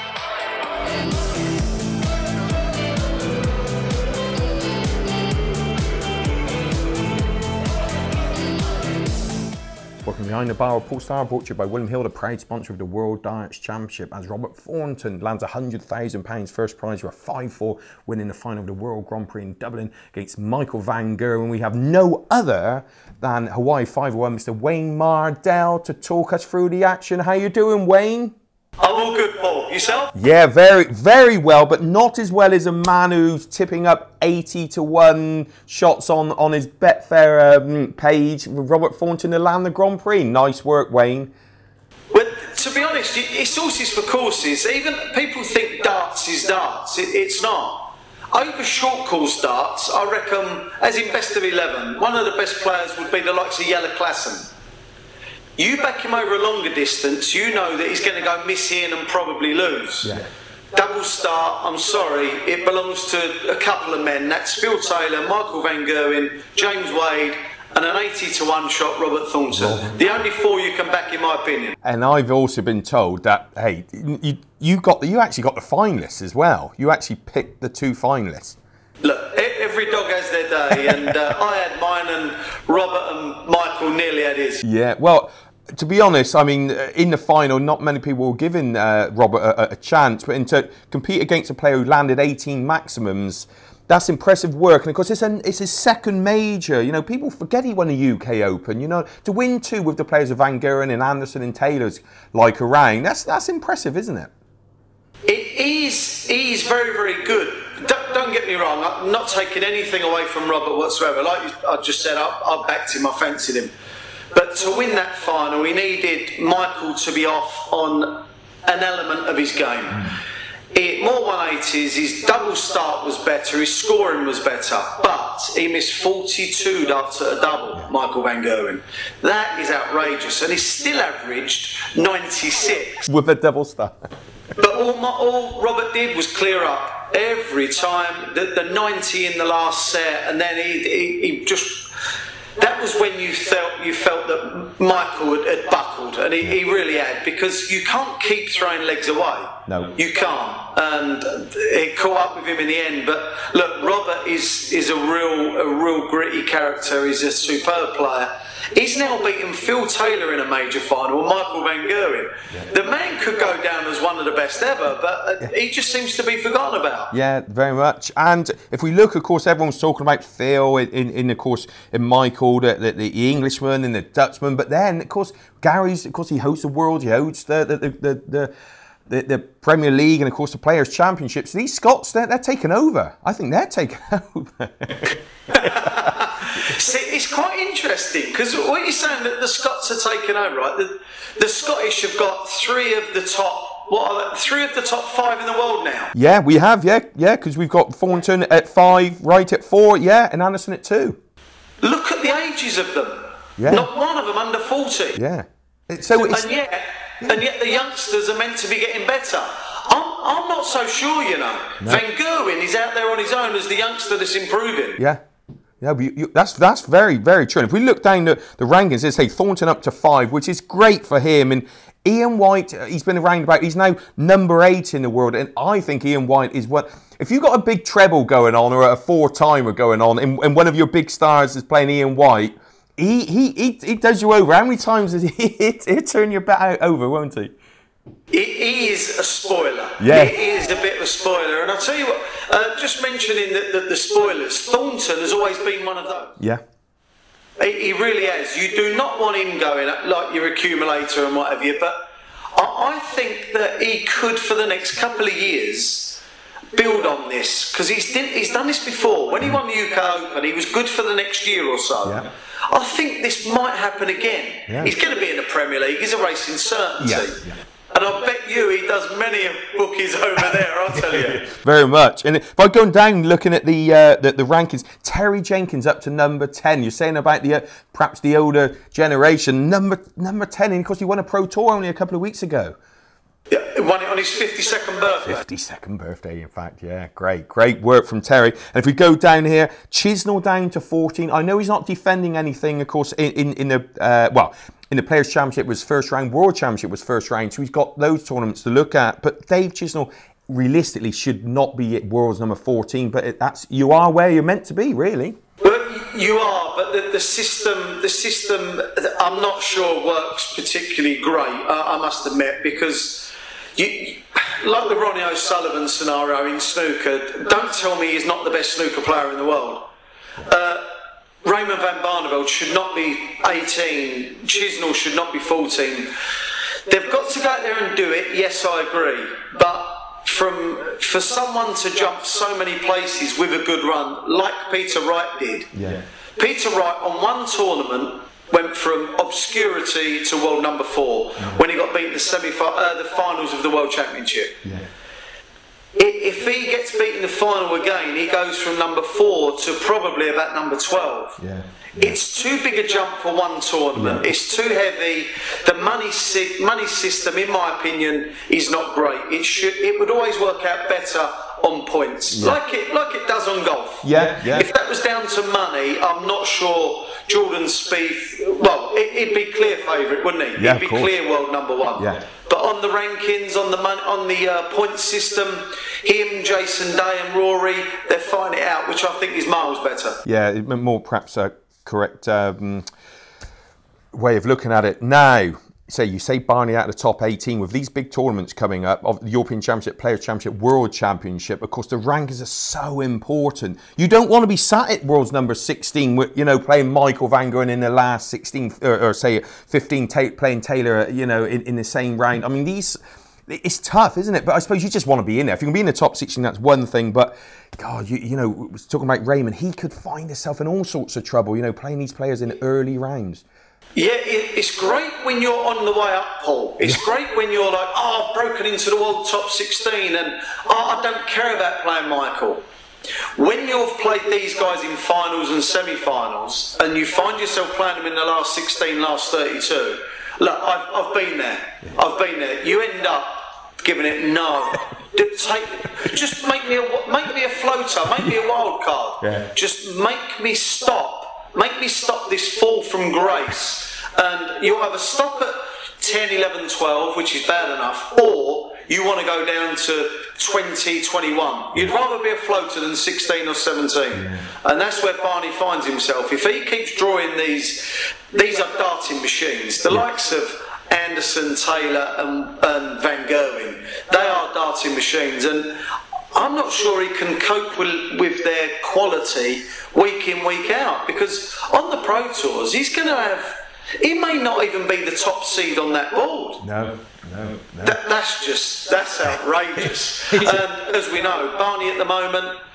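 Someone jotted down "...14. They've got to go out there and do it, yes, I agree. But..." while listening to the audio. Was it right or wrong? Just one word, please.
right.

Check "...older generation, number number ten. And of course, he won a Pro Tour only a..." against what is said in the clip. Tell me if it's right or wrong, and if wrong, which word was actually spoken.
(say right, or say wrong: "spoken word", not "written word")
right.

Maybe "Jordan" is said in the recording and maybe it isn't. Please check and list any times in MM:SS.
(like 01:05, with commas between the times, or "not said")
06:07.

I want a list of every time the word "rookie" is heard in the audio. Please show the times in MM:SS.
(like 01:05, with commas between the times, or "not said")
not said.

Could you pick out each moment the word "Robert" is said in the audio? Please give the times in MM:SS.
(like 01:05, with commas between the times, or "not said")
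00:14, 00:38, 01:08, 01:22, 01:29, 01:50, 02:15, 02:33.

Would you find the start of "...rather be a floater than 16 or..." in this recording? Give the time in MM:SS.
07:31.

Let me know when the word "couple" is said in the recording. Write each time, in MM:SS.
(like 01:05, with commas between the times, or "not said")
01:03, 04:14, 04:41.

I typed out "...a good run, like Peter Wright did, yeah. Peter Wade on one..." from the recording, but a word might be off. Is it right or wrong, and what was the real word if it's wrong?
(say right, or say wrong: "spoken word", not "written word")
wrong: "Wright", not "Wade".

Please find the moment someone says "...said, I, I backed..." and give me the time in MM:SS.
01:52.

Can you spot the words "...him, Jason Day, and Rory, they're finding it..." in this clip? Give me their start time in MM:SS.
06:16.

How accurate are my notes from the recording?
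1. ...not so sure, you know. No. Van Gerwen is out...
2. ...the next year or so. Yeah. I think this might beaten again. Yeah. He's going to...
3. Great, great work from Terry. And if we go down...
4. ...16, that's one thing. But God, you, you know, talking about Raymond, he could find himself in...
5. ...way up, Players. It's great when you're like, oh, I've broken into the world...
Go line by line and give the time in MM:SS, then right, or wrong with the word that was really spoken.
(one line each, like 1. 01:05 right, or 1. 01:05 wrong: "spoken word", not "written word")
1. 03:30 right
2. 04:21 wrong: "happen", not "beaten"
3. 04:47 right
4. 06:46 right
5. 06:55 wrong: "Paul", not "Players".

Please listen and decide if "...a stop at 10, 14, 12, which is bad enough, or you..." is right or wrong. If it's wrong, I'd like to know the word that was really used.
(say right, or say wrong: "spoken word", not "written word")
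wrong: "11", not "14".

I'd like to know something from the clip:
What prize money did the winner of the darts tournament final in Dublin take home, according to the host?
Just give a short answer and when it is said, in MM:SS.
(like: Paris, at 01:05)
£100,000, at 00:15.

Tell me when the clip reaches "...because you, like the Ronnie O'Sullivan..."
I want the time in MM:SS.
05:12.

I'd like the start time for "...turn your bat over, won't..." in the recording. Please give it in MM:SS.
03:56.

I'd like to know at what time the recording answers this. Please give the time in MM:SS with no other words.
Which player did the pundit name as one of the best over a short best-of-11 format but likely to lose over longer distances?
00:53.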